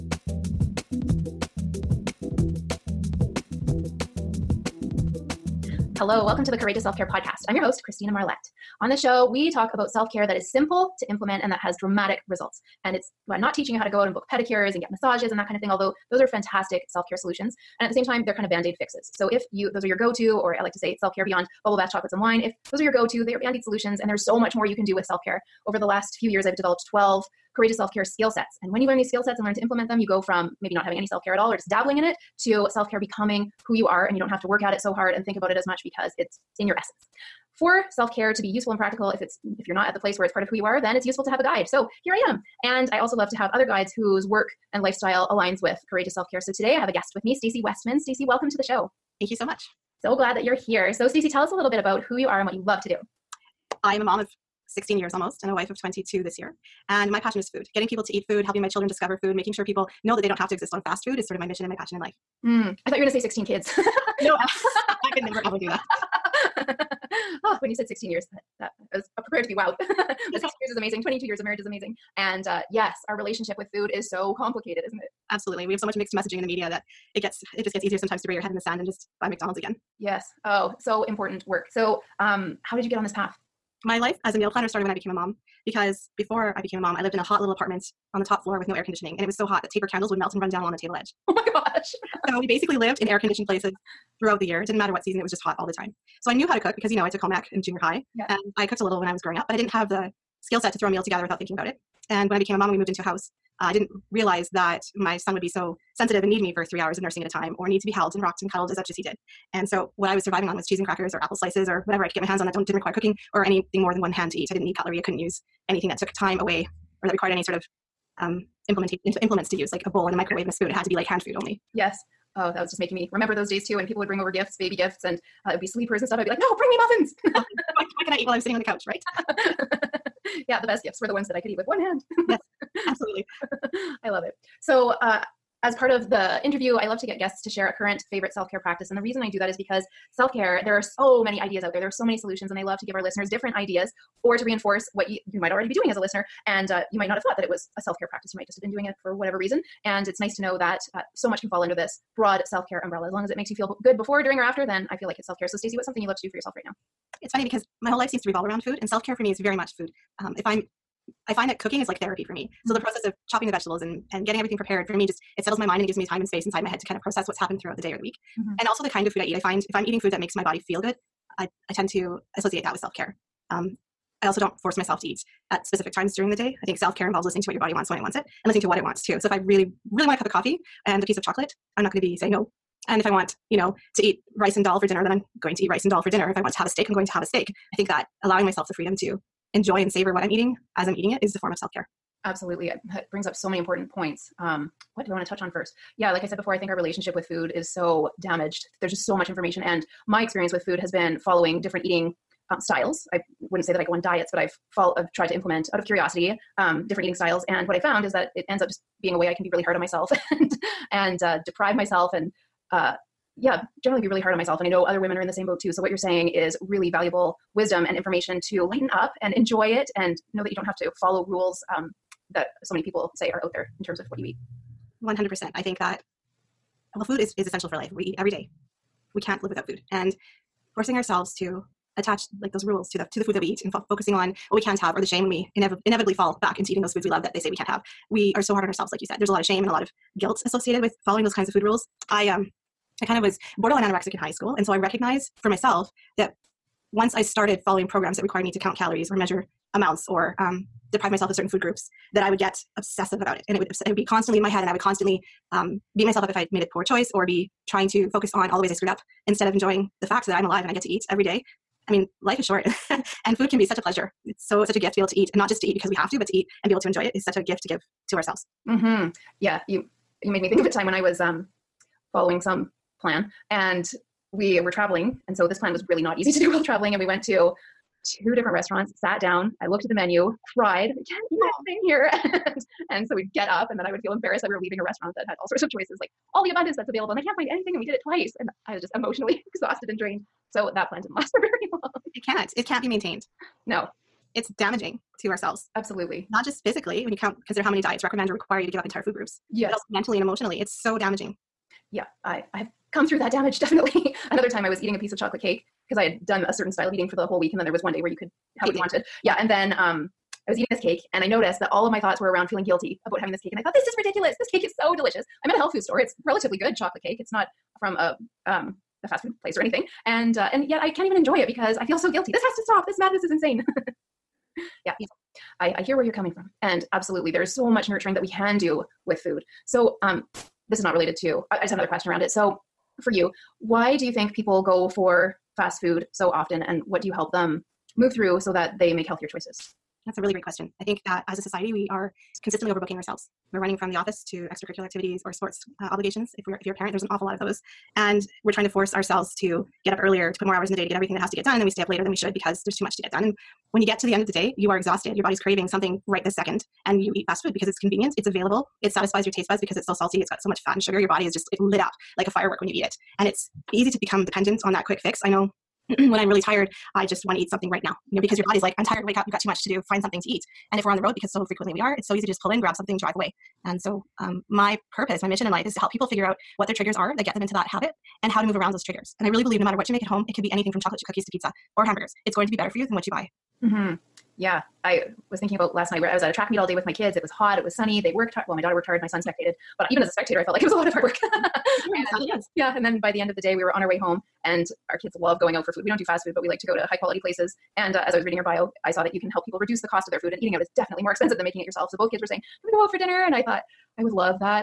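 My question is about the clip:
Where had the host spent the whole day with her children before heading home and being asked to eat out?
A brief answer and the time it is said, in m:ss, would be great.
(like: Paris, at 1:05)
A track meet, at 6:26.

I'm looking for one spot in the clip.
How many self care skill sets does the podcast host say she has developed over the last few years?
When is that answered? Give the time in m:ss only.
0:26.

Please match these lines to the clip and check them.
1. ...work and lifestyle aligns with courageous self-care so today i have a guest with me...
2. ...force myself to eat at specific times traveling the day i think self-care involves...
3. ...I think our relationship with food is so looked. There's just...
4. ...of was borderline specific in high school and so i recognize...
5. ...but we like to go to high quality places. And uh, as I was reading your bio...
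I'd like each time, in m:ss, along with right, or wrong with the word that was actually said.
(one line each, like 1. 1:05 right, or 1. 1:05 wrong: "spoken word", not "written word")
1. 0:44 right
2. 2:54 wrong: "during", not "traveling"
3. 3:16 wrong: "damaged", not "looked"
4. 4:03 wrong: "anorexic", not "specific"
5. 6:36 right.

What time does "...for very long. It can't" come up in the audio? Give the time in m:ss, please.
4:51.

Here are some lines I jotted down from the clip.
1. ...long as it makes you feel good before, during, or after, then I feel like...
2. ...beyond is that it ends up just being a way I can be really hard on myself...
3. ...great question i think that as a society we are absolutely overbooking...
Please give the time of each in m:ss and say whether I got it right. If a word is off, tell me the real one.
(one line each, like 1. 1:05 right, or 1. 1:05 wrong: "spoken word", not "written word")
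1. 2:33 right
2. 3:27 wrong: "found", not "beyond"
3. 5:40 wrong: "consistently", not "absolutely".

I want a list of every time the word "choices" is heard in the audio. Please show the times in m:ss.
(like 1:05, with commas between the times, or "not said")
4:16, 4:45, 5:39.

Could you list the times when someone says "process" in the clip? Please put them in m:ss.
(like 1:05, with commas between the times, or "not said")
2:42, 2:47.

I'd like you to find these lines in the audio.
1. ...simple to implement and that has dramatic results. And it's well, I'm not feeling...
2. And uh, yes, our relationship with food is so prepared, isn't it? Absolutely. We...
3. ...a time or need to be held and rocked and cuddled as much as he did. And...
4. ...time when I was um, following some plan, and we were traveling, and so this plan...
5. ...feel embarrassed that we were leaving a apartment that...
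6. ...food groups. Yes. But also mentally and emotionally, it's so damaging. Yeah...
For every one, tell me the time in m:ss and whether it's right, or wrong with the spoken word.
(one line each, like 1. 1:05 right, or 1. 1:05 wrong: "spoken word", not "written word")
1. 0:10 wrong: "teaching", not "feeling"
2. 1:12 wrong: "complicated", not "prepared"
3. 1:47 right
4. 4:30 right
5. 4:44 wrong: "restaurant", not "apartment"
6. 4:59 right.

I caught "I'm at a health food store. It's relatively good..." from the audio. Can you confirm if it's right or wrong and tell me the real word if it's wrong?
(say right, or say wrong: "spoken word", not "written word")
right.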